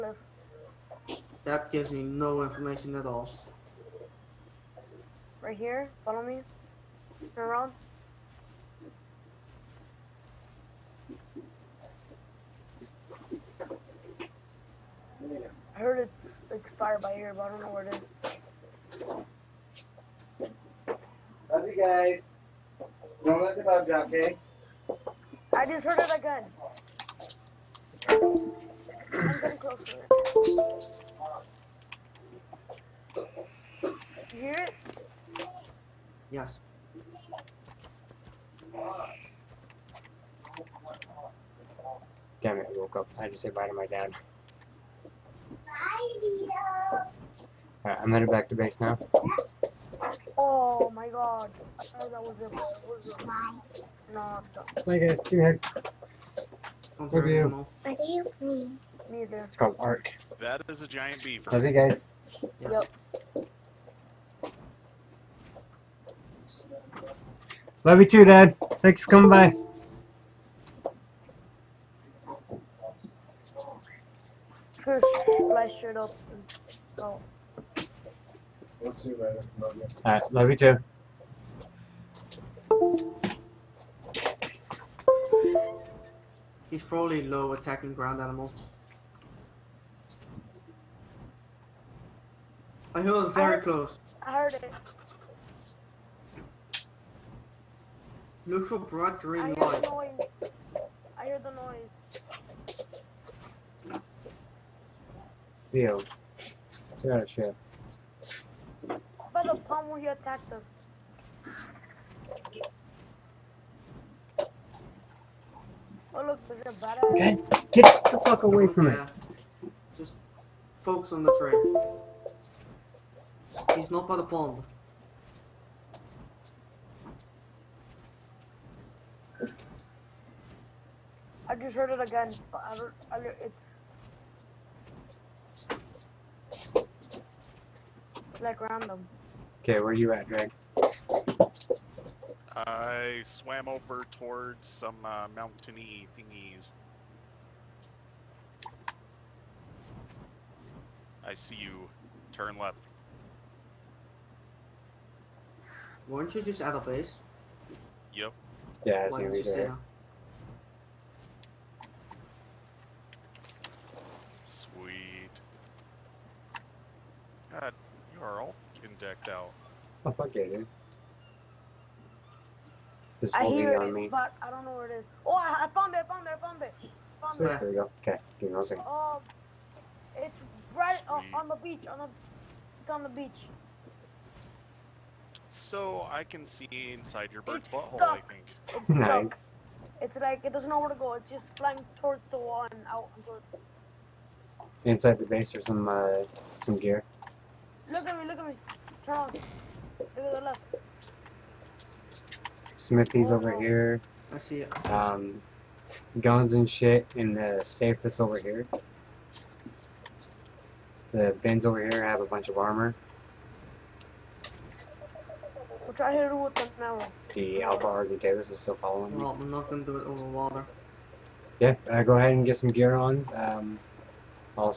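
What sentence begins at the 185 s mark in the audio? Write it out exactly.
So I can see inside your bird's it's butthole, stuck.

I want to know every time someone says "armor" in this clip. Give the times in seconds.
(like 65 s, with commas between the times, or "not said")
212 s.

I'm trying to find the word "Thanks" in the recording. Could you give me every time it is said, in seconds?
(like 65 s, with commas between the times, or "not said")
68 s.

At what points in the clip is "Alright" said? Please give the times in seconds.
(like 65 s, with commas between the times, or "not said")
47 s, 80 s.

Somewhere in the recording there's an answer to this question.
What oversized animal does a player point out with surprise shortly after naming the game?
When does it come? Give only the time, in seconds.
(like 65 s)
60 s.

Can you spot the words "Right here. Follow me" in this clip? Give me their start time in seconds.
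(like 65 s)
5 s.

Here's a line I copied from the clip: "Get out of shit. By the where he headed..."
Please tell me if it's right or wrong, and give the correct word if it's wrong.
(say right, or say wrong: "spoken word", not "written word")
wrong: "attacked", not "headed".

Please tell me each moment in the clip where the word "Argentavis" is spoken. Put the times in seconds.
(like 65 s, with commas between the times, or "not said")
217 s.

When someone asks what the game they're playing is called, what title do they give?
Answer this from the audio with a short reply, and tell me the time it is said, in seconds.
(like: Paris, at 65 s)
Ark, at 59 s.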